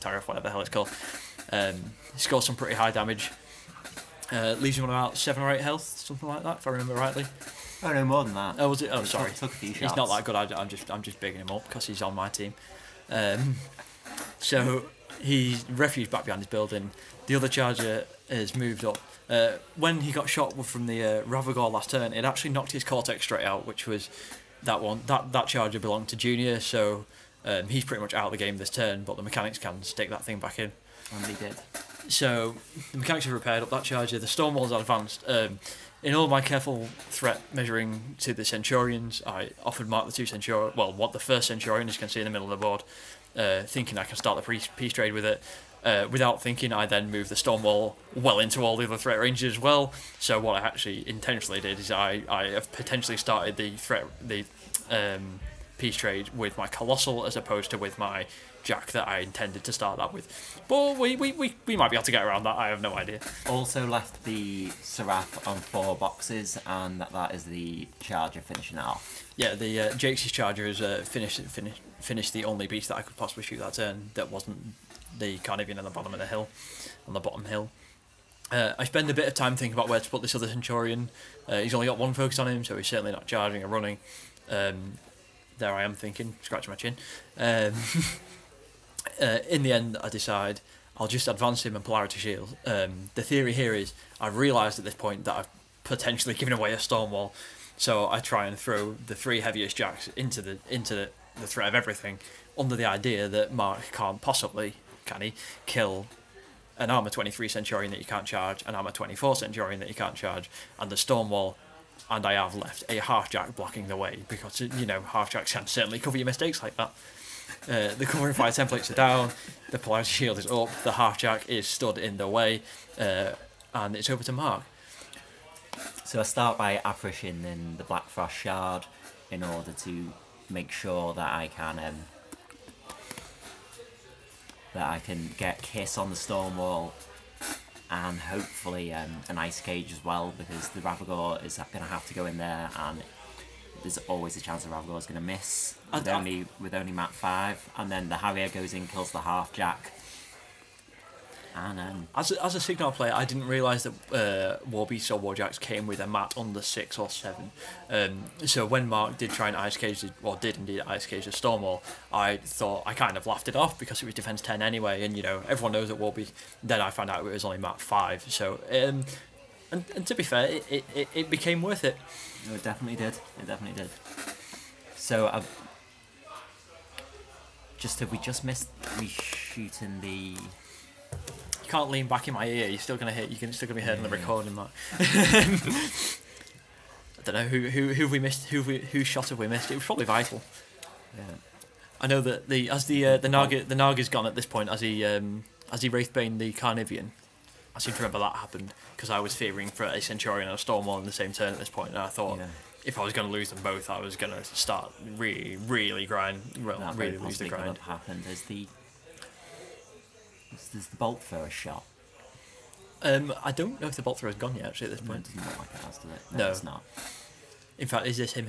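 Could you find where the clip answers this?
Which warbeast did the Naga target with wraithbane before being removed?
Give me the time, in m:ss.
3:16.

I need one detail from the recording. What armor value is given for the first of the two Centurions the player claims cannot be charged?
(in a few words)
23.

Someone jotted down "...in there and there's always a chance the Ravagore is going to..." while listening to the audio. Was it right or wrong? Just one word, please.
right.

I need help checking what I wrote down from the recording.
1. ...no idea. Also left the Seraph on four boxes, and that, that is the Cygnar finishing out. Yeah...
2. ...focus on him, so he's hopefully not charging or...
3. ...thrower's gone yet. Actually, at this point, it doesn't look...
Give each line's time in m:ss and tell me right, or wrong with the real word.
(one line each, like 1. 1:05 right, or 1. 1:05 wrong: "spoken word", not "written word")
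1. 1:02 wrong: "Charger", not "Cygnar"
2. 1:22 wrong: "certainly", not "hopefully"
3. 3:34 right.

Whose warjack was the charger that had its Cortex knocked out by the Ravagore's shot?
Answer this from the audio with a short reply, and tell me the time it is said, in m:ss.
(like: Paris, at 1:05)
Junior, at 0:26.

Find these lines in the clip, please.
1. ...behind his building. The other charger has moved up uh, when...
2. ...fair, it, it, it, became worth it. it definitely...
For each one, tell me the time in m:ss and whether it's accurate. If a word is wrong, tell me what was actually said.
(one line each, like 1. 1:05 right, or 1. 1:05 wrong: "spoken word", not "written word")
1. 0:16 right
2. 2:50 right.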